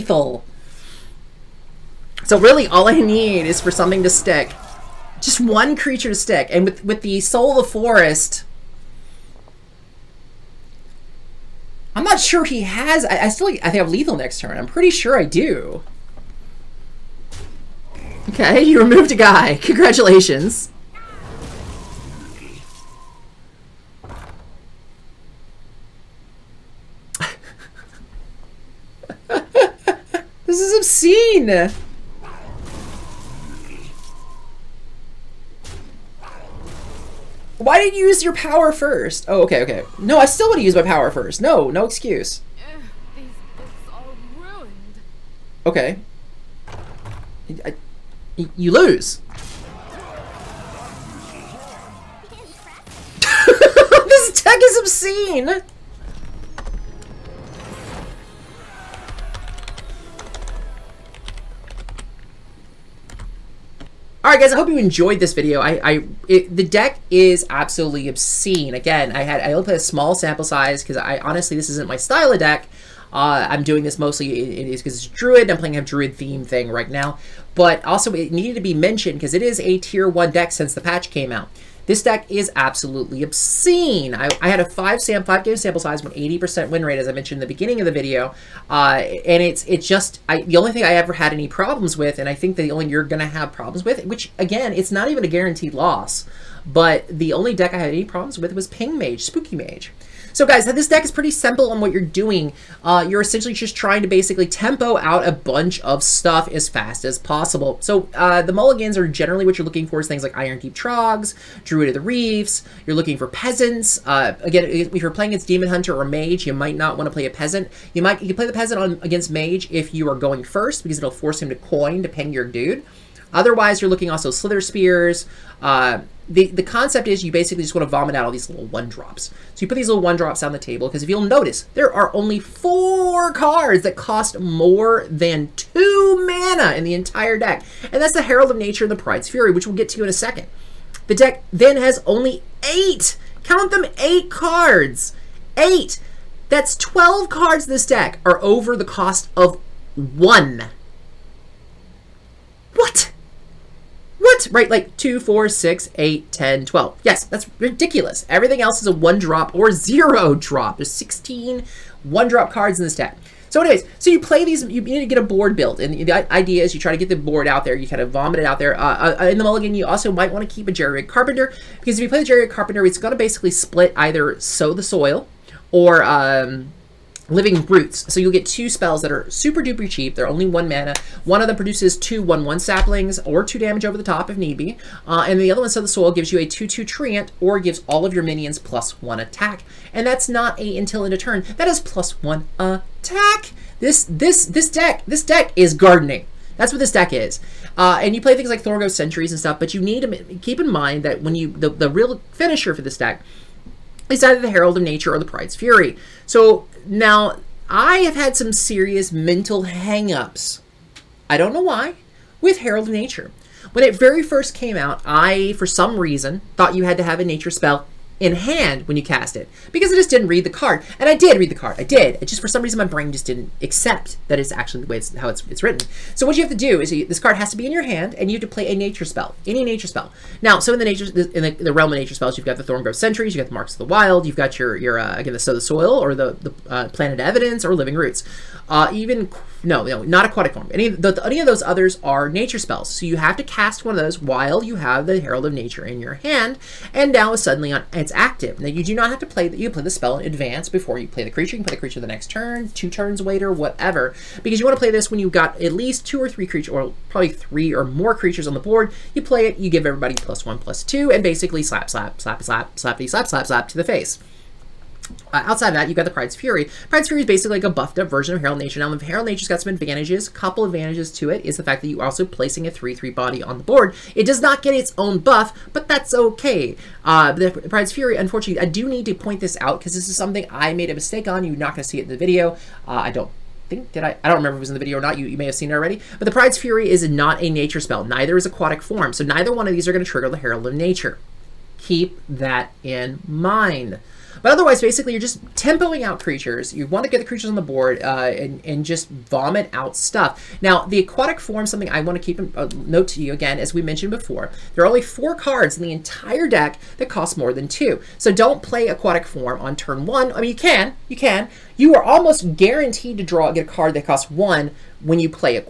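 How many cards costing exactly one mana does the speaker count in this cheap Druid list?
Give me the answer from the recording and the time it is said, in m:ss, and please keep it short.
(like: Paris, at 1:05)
16, at 2:40.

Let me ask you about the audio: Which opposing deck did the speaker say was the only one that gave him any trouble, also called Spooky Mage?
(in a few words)
Ping Mage.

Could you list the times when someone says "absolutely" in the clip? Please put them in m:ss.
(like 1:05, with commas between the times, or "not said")
1:07, 1:22.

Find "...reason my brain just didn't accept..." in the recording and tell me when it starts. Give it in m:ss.
3:42.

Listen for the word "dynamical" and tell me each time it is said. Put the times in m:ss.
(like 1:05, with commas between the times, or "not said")
not said.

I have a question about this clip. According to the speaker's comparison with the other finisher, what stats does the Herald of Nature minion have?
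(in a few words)
3-3.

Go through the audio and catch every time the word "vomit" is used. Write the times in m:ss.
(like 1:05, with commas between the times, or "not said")
2:07, 2:48, 4:59.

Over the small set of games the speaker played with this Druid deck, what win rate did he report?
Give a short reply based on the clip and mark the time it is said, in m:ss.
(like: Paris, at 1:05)
80%, at 1:26.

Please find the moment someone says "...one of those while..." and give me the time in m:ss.
4:03.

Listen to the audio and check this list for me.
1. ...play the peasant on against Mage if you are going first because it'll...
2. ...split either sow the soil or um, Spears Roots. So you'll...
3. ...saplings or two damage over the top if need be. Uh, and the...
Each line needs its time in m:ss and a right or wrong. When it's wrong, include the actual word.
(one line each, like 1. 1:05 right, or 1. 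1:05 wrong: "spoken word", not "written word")
1. 1:58 right
2. 2:53 wrong: "Living", not "Spears"
3. 3:02 right.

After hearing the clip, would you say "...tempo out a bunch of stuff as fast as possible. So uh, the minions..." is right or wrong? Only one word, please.
wrong.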